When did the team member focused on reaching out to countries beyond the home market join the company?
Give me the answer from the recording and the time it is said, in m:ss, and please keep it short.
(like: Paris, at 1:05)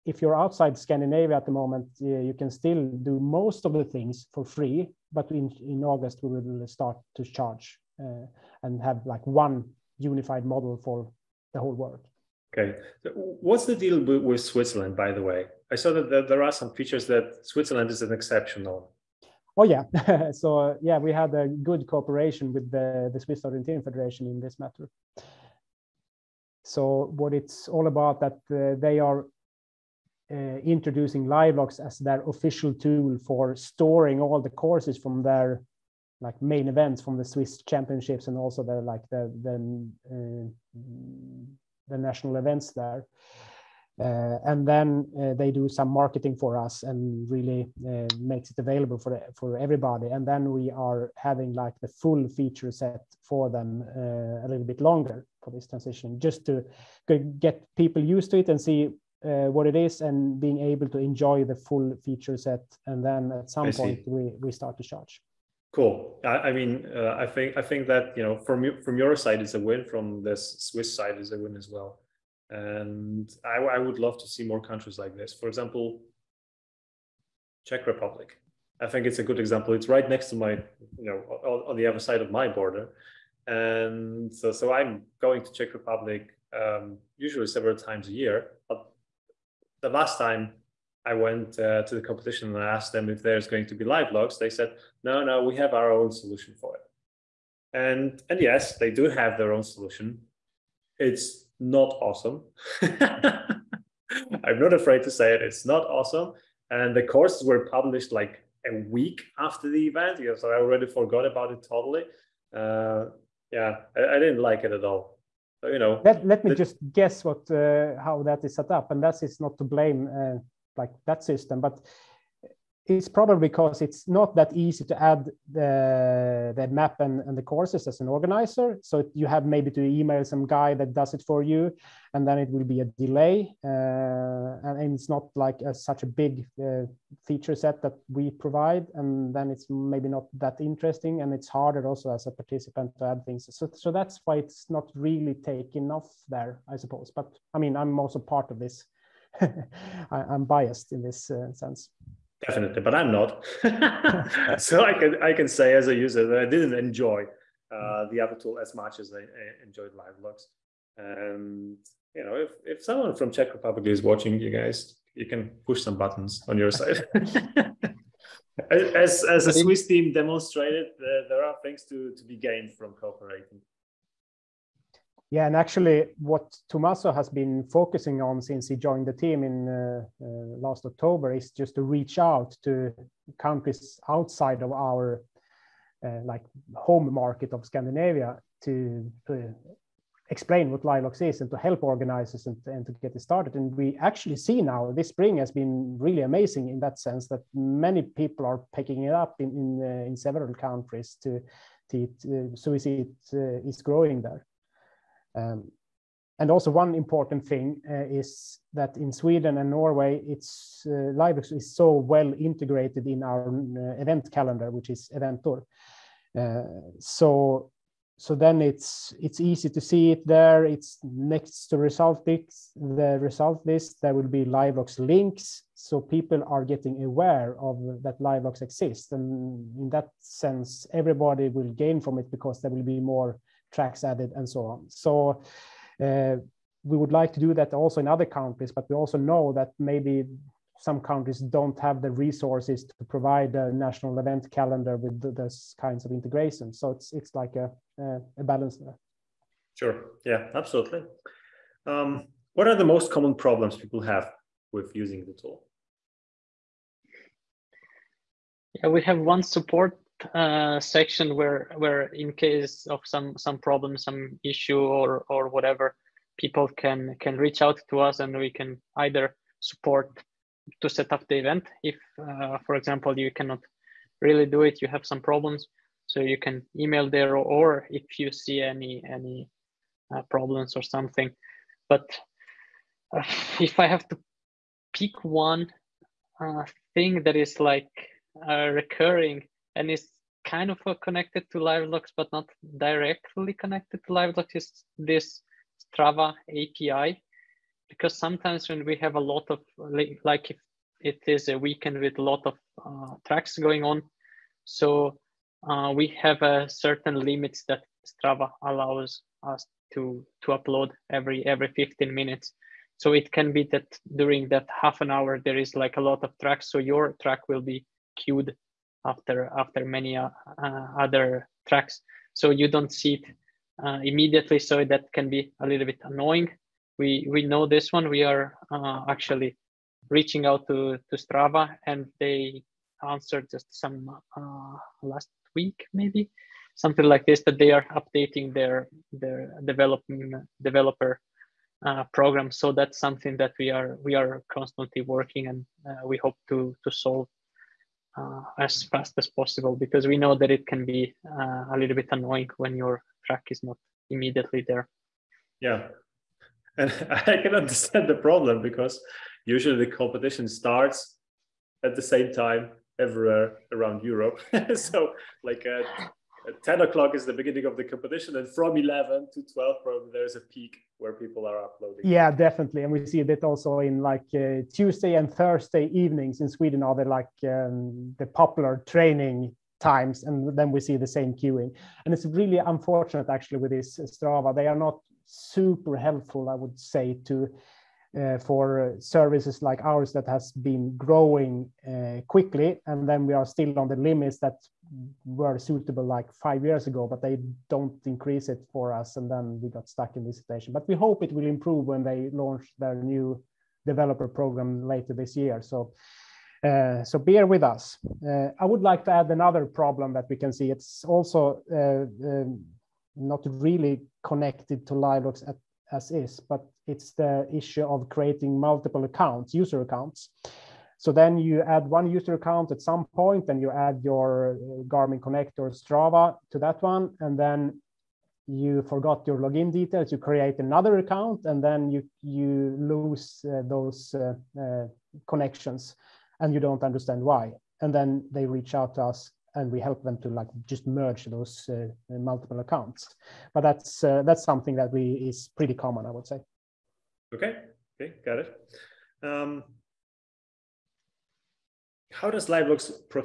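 last October, at 3:00.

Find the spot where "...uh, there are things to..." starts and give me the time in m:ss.
2:50.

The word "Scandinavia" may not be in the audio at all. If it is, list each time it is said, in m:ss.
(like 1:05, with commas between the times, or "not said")
0:00, 3:07.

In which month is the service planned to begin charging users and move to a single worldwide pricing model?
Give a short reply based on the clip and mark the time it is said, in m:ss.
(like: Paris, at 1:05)
August, at 0:05.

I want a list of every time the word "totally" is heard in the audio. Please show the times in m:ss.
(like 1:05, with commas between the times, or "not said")
1:51.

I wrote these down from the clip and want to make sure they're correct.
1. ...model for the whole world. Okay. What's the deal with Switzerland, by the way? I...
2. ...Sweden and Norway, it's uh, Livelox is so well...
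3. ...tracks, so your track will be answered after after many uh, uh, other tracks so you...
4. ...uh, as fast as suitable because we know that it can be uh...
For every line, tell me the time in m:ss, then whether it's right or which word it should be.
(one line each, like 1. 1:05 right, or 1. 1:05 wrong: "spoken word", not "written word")
1. 0:10 right
2. 3:29 right
3. 5:16 wrong: "queued", not "answered"
4. 5:48 wrong: "possible", not "suitable".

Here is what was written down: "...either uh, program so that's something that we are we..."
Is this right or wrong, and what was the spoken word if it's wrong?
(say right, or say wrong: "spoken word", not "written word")
wrong: "developer", not "either".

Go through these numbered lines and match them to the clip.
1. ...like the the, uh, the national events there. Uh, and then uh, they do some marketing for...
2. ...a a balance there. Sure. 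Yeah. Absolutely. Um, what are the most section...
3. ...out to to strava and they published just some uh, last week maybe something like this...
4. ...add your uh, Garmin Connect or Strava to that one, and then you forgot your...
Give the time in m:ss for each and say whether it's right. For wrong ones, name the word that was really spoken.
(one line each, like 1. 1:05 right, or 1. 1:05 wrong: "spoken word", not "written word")
1. 0:38 right
2. 4:07 wrong: "common", not "section"
3. 5:30 wrong: "answered", not "published"
4. 7:03 right.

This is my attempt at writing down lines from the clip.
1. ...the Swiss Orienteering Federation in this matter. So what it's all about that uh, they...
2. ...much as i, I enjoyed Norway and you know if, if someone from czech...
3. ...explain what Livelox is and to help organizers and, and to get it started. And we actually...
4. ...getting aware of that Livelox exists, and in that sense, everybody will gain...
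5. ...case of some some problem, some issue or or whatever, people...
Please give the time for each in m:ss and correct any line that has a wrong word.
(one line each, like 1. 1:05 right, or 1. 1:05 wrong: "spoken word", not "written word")
1. 0:23 right
2. 2:38 wrong: "Livelox", not "Norway"
3. 3:10 right
4. 3:46 right
5. 4:22 right.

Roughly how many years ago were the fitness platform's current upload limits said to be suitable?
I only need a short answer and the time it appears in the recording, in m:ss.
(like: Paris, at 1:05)
5, at 6:36.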